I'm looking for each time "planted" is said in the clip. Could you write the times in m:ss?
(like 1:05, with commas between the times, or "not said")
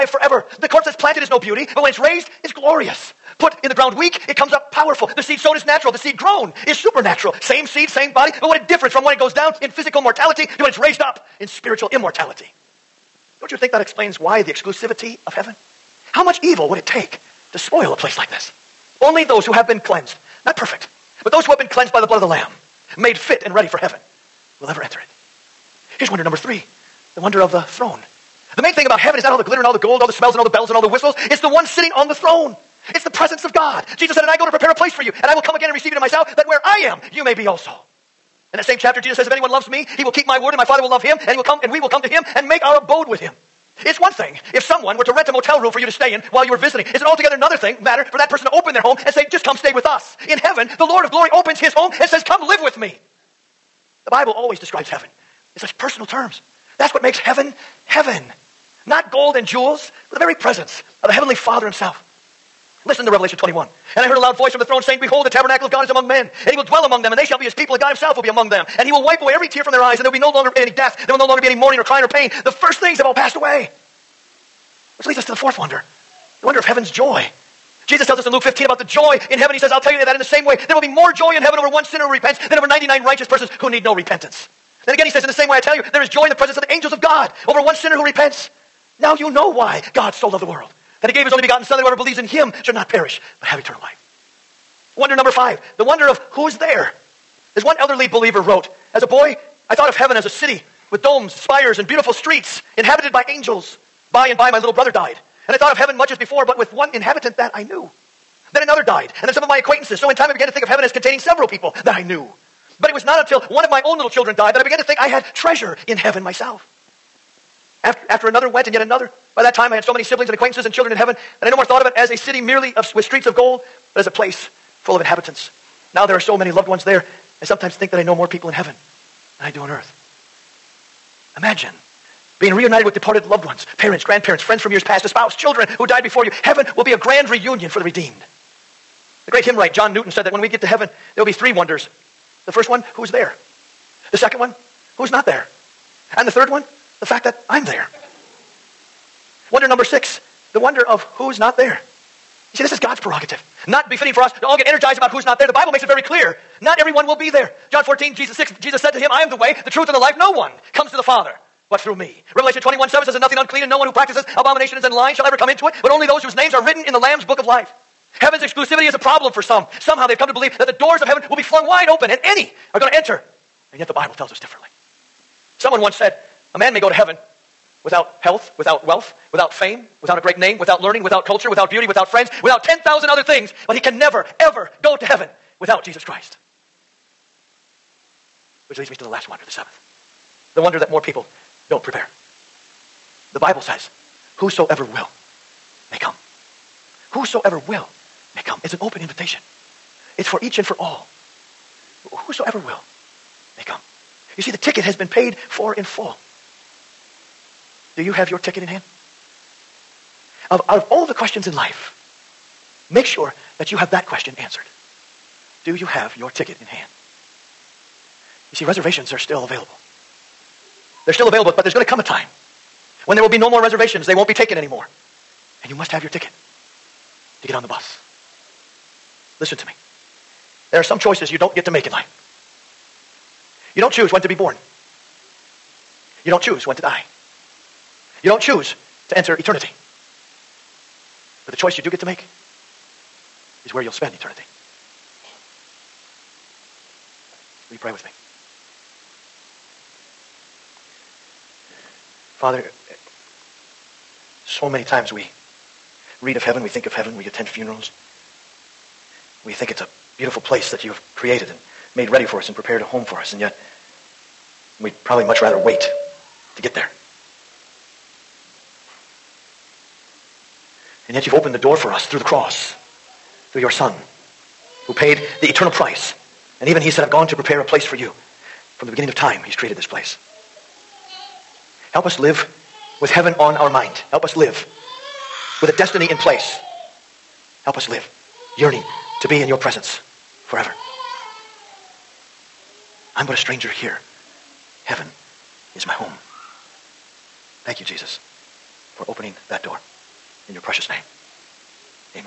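0:00.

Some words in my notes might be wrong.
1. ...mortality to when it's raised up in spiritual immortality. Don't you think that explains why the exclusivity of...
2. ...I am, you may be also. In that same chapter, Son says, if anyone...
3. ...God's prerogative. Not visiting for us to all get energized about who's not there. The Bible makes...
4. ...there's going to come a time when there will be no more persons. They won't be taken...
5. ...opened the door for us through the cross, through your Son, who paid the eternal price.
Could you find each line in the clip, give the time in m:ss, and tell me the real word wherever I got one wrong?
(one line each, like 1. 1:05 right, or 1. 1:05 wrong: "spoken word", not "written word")
1. 0:10 right
2. 0:36 wrong: "Jesus", not "Son"
3. 2:32 wrong: "befitting", not "visiting"
4. 3:41 wrong: "reservations", not "persons"
5. 4:31 right.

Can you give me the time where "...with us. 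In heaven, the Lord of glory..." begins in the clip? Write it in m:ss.
0:49.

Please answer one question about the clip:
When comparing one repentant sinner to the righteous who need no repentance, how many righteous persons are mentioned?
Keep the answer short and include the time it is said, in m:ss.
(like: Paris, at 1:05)
99, at 1:22.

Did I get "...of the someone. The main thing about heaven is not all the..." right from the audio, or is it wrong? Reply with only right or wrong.
wrong.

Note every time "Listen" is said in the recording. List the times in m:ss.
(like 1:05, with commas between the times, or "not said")
1:02, 3:49.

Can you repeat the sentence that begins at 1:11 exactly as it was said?
There will no longer be any mourning or crying or pain.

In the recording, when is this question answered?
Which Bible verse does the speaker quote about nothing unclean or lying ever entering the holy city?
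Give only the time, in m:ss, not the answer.
2:42.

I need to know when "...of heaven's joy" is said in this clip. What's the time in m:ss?
1:16.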